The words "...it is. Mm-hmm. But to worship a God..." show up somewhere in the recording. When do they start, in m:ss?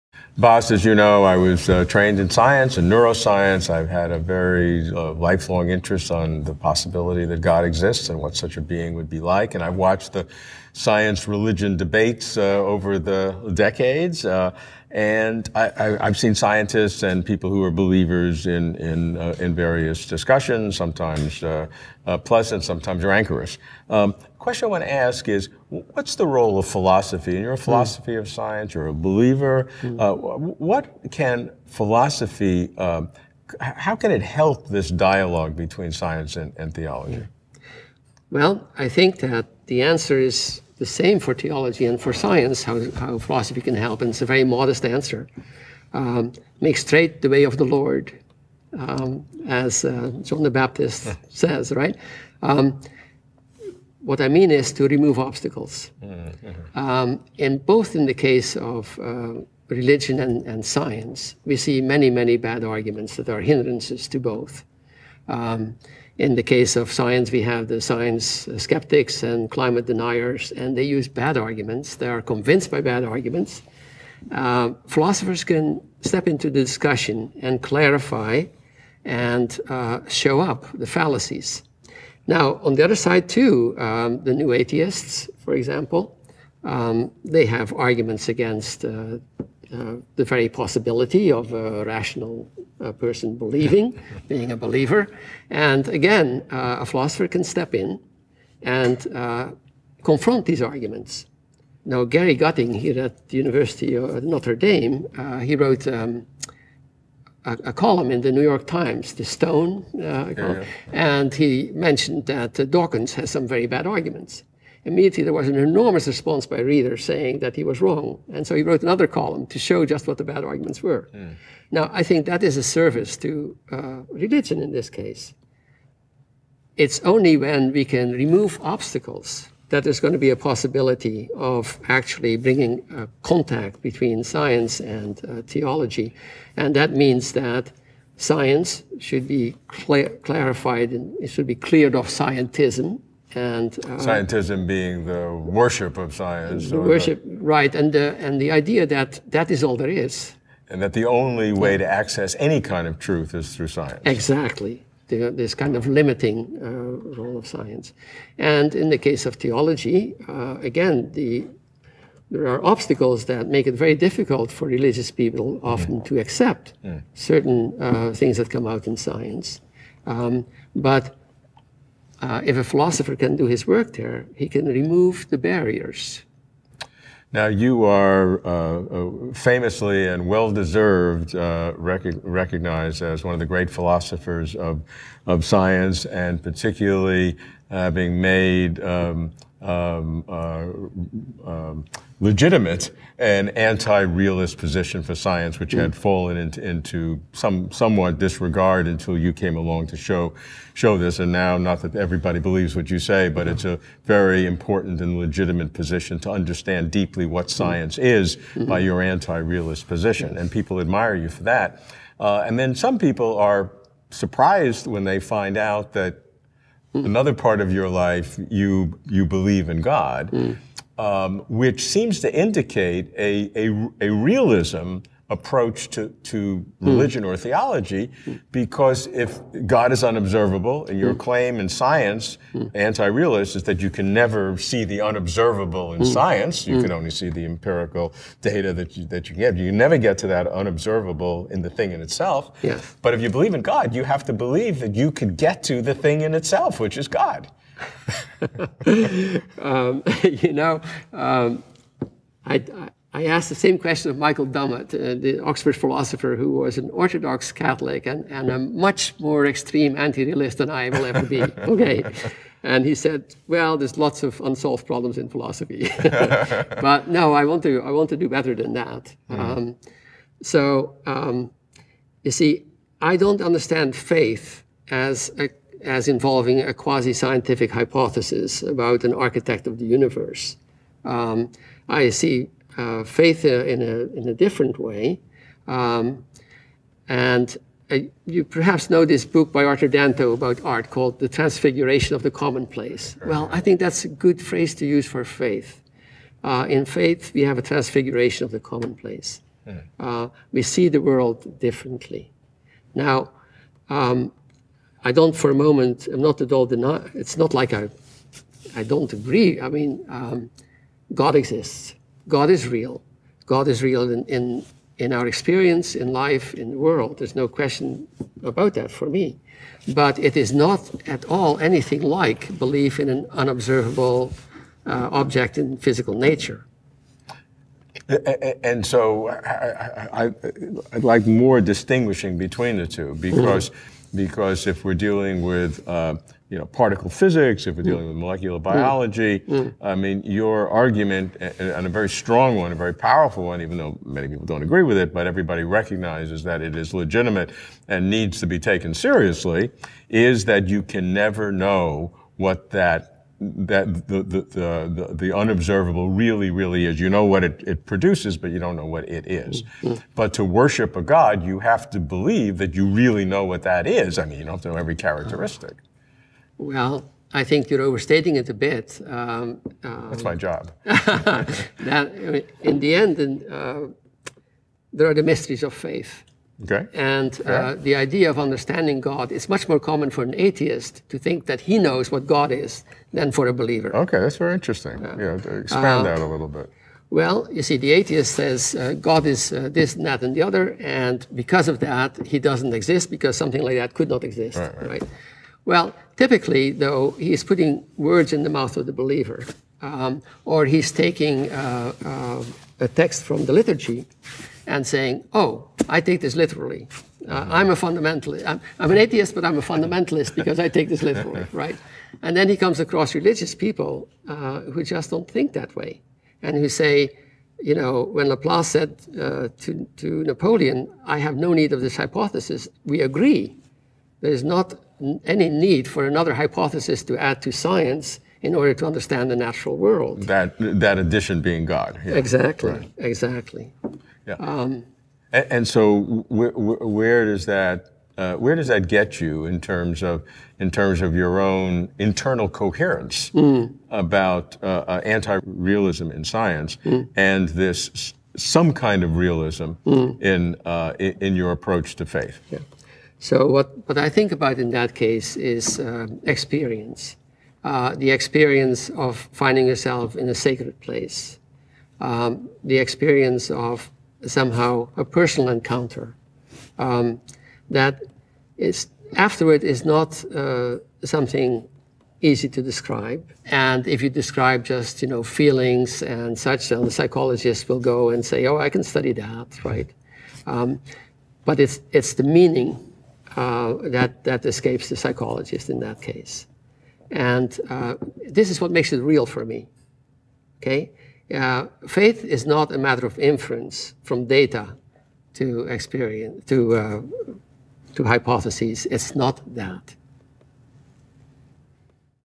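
5:59.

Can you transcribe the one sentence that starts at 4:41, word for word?
Um, I see uh, faith in a, in a different way.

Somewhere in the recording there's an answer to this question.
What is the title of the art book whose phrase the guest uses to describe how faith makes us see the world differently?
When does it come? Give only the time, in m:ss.
4:51.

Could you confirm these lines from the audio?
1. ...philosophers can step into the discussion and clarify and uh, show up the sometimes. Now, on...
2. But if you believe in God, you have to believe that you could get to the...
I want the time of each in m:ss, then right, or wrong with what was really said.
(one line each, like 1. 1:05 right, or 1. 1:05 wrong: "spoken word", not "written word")
1. 1:14 wrong: "fallacies", not "sometimes"
2. 4:03 right.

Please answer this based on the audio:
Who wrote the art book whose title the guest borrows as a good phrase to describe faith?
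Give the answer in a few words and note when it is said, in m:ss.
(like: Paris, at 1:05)
Arthur Danto, at 4:49.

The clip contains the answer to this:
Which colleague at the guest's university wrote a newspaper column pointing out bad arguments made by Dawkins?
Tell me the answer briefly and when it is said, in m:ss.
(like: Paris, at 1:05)
Gary Gutting, at 1:42.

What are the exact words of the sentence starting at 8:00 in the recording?
Um, but it's, it's the meaning uh, that, that escapes the psychologist in that case.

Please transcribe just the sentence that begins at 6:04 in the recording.
I mean, you don't know every characteristic.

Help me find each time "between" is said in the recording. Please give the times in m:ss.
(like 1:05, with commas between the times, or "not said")
0:35, 2:13, 5:32.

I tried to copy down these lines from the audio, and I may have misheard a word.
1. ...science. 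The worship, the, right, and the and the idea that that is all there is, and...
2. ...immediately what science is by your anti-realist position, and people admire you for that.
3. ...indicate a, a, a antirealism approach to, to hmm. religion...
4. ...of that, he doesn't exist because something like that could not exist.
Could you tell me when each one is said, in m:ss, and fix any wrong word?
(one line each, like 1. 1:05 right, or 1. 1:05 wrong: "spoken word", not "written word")
1. 2:26 right
2. 3:26 wrong: "deeply", not "immediately"
3. 3:42 wrong: "realism", not "antirealism"
4. 6:31 right.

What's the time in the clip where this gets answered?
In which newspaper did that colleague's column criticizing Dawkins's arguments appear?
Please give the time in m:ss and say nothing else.
1:48.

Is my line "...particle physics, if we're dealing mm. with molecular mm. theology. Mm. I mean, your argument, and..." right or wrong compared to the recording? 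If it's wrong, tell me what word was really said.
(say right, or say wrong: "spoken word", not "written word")
wrong: "biology", not "theology".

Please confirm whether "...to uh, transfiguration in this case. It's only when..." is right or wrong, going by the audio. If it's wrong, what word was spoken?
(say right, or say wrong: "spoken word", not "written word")
wrong: "religion", not "transfiguration".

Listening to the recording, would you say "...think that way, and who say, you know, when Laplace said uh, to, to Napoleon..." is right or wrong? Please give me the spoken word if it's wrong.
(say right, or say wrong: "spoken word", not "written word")
right.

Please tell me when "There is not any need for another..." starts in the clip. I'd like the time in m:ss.
7:04.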